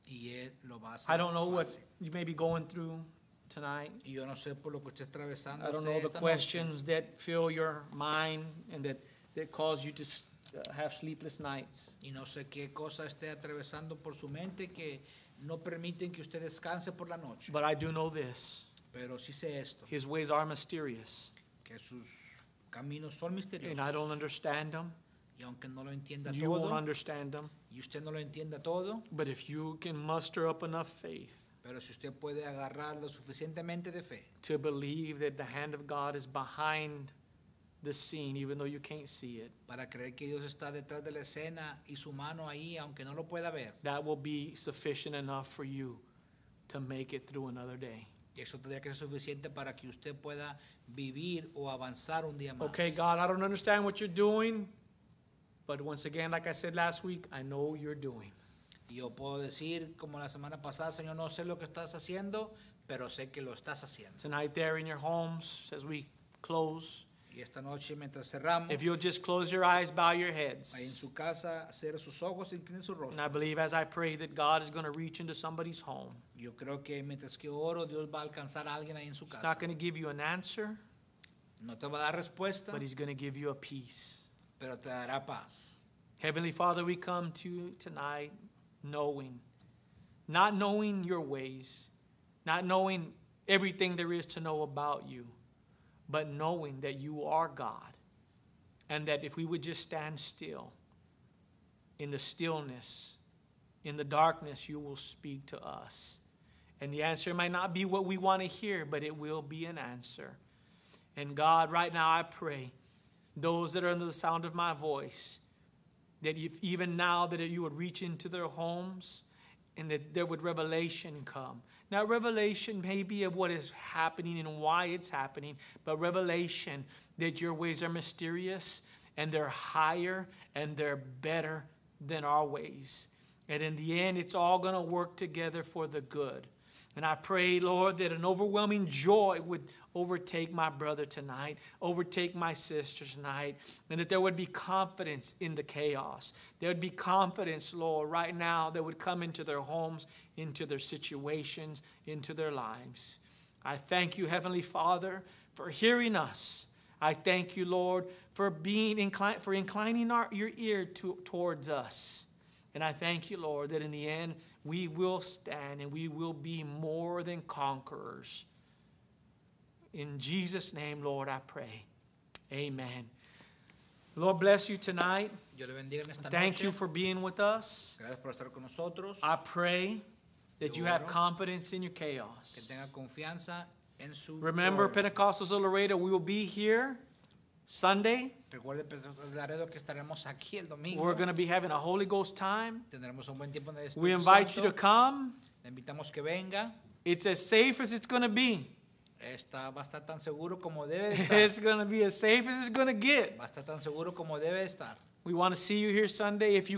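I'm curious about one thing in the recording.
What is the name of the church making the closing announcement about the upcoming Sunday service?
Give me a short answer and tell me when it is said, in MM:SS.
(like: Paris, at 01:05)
Pentecostals of Laredo, at 03:05.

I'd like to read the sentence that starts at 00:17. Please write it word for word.
But I do know this Pero sí sé esto, His ways are mysterious, que sus Caminos son and I don't understand them.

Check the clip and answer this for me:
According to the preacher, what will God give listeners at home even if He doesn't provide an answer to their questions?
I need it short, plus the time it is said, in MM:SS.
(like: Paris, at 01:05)
Peace, at 01:22.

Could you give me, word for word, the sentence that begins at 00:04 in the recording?
Y yo no sé por lo que usted atravesando.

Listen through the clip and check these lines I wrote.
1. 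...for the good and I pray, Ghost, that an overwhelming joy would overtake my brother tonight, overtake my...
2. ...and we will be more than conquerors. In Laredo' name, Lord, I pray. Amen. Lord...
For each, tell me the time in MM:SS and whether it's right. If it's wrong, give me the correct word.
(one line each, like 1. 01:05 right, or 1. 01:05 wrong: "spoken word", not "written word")
1. 02:15 wrong: "Lord", not "Ghost"
2. 02:45 wrong: "Jesus", not "Laredo".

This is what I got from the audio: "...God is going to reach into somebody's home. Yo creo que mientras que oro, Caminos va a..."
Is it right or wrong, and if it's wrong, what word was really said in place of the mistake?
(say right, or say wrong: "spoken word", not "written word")
wrong: "Dios", not "Caminos".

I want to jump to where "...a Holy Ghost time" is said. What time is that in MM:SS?
03:11.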